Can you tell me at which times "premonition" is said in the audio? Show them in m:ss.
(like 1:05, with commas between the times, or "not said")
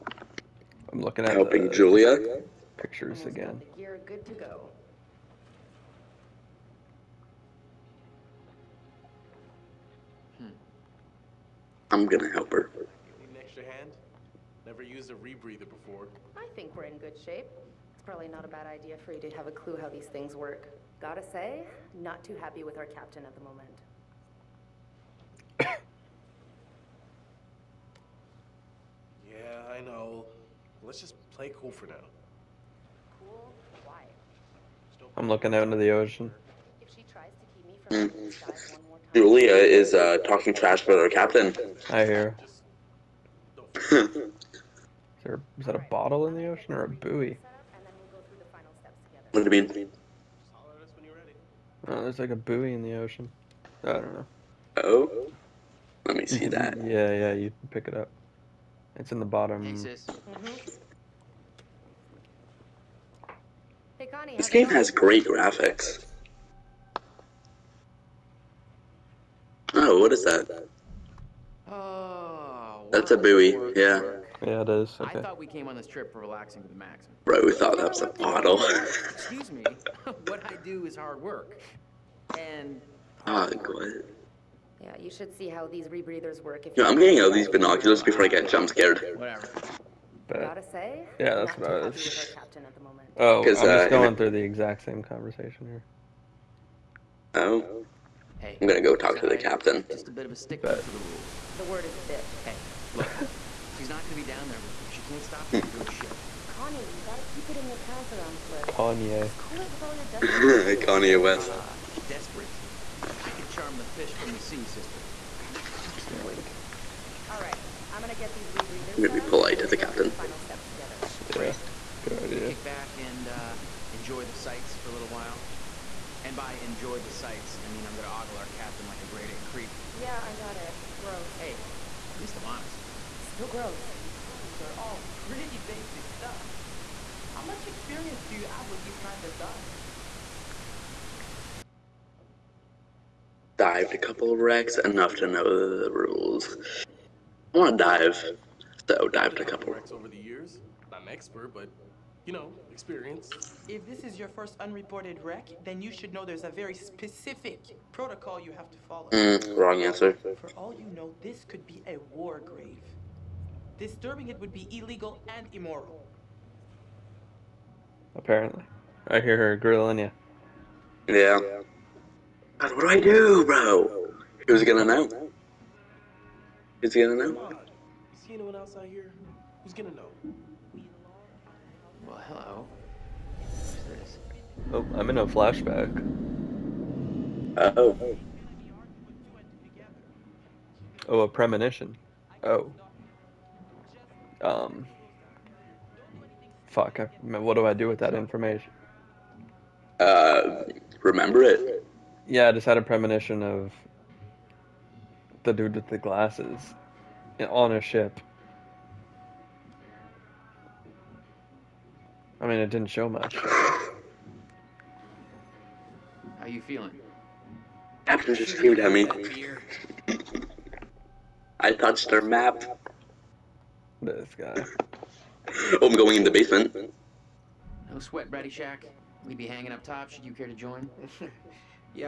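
3:11, 3:22.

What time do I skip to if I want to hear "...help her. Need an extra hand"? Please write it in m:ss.
0:12.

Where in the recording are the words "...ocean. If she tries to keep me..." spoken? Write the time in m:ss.
0:35.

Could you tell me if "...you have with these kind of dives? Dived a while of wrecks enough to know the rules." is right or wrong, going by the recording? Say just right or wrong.
wrong.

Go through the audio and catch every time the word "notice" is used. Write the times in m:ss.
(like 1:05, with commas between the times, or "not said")
not said.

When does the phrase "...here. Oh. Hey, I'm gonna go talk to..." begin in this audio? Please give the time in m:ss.
1:35.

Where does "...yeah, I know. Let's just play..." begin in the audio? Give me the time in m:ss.
0:29.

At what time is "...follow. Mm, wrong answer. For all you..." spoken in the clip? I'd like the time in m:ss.
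2:38.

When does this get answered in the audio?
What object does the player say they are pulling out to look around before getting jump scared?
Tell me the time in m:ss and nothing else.
1:27.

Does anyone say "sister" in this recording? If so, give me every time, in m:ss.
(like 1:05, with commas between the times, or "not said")
1:54.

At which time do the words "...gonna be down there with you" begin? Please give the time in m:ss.
1:44.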